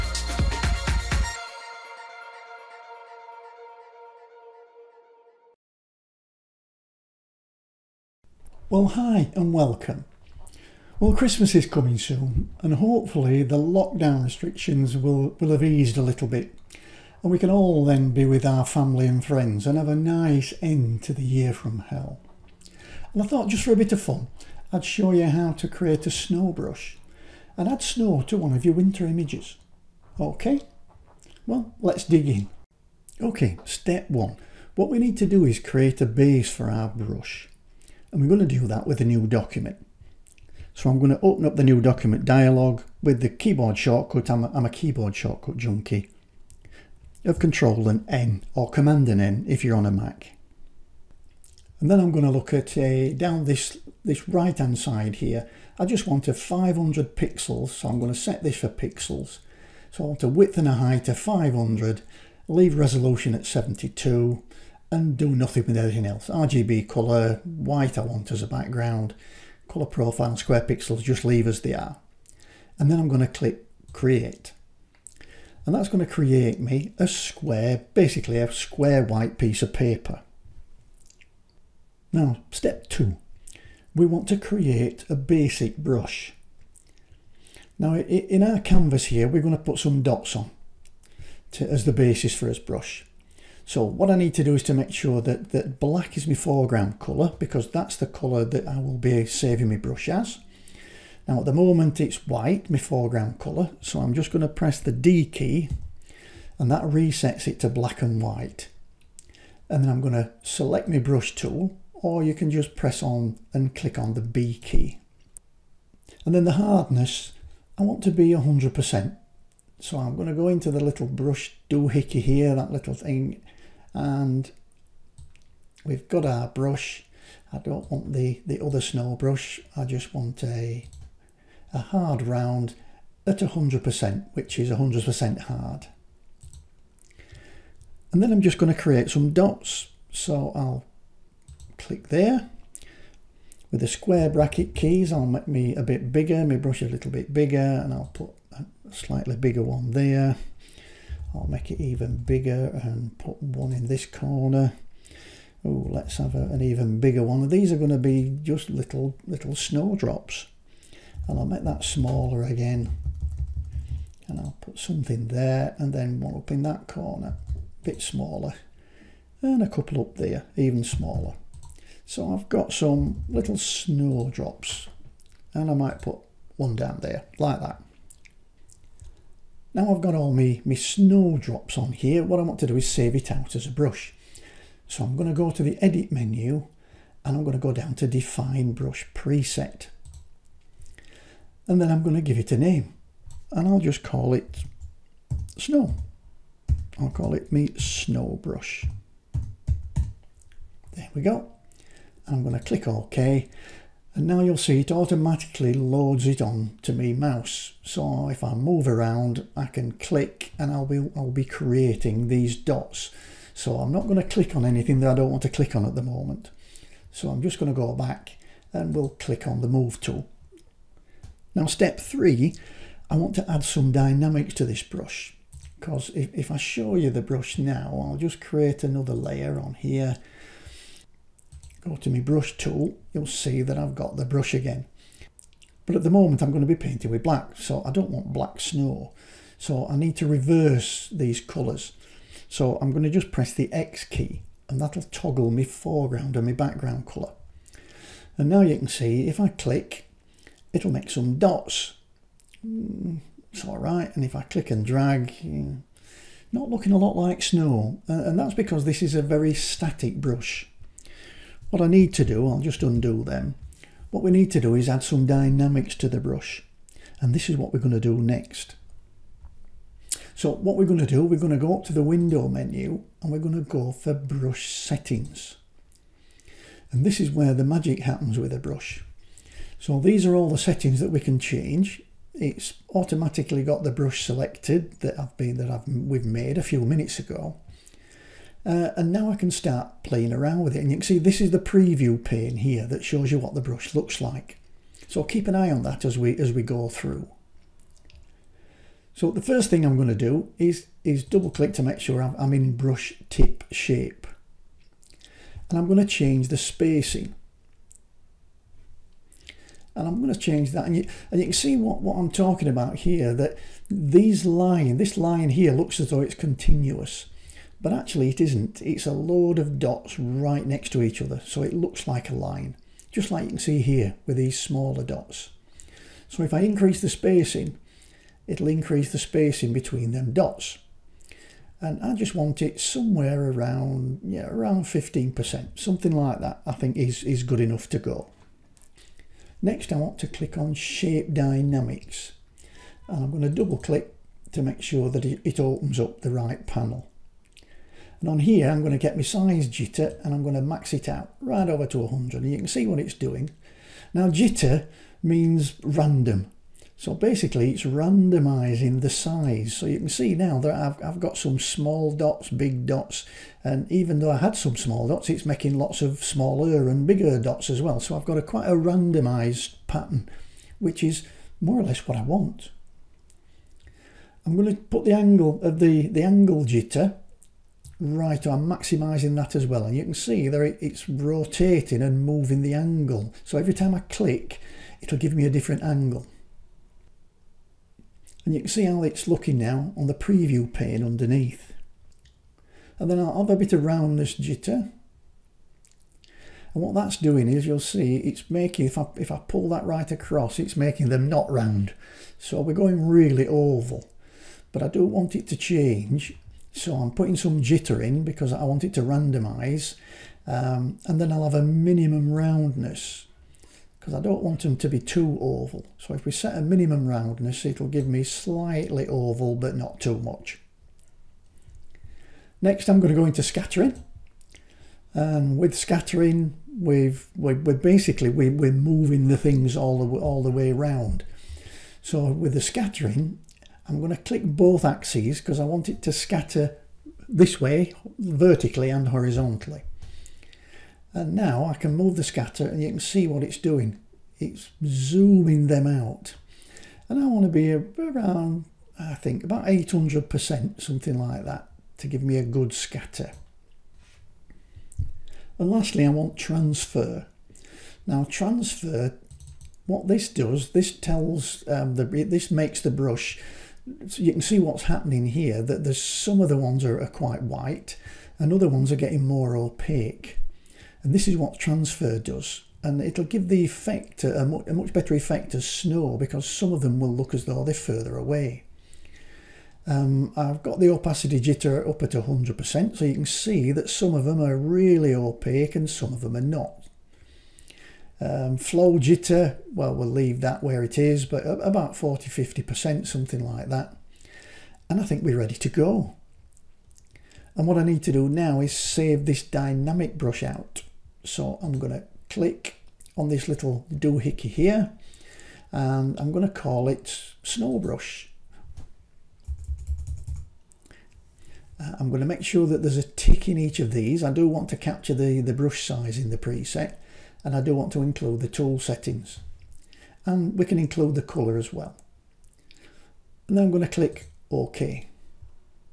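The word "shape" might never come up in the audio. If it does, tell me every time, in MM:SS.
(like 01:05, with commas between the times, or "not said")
05:03, 05:40.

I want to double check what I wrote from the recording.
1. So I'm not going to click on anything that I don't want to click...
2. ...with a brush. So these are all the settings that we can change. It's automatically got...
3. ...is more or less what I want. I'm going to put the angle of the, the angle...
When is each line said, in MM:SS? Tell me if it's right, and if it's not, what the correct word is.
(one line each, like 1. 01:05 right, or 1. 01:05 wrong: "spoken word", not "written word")
1. 03:33 right
2. 04:38 right
3. 06:11 right.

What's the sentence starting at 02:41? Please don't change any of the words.
And I'll make that smaller again.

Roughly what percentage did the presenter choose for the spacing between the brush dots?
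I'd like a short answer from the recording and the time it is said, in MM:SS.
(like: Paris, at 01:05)
15%, at 05:34.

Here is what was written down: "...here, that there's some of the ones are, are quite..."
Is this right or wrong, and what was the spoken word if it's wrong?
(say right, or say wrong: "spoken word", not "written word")
right.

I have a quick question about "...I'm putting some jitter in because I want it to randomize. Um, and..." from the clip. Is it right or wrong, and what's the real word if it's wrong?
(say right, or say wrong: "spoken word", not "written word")
right.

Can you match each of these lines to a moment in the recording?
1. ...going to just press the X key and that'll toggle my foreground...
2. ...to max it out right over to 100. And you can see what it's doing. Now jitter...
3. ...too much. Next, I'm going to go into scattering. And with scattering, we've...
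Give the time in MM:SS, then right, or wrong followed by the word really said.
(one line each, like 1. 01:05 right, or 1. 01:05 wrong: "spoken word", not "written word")
1. 04:02 right
2. 05:50 right
3. 06:59 right.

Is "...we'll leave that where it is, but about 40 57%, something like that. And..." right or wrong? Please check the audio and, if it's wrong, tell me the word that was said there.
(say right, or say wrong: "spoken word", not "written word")
wrong: "50", not "57".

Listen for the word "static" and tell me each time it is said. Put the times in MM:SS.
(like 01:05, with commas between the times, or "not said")
04:19.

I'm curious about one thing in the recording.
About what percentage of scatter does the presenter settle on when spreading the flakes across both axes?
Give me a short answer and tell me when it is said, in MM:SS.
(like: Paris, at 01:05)
800%, at 07:29.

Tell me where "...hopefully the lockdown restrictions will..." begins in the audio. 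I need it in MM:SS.
00:12.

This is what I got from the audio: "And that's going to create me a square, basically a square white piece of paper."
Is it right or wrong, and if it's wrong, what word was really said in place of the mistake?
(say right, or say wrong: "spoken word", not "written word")
right.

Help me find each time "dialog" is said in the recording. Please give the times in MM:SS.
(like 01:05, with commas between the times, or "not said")
00:42.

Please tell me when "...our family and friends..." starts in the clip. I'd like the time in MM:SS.
00:18.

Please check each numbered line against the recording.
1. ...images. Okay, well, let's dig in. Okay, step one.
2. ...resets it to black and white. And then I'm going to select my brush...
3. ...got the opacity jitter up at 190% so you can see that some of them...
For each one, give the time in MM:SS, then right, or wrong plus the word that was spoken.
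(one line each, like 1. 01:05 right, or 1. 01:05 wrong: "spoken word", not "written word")
1. 00:29 right
2. 01:46 right
3. 08:00 wrong: "100", not "190".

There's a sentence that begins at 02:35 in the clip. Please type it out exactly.
Oh, let's have a, an even bigger one.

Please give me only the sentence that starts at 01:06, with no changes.
RGB colour, white I want as a background, colour profile, square pixels, just leave as they are.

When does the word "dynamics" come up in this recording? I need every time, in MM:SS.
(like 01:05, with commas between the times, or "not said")
03:43, 04:25, 05:41, 08:19.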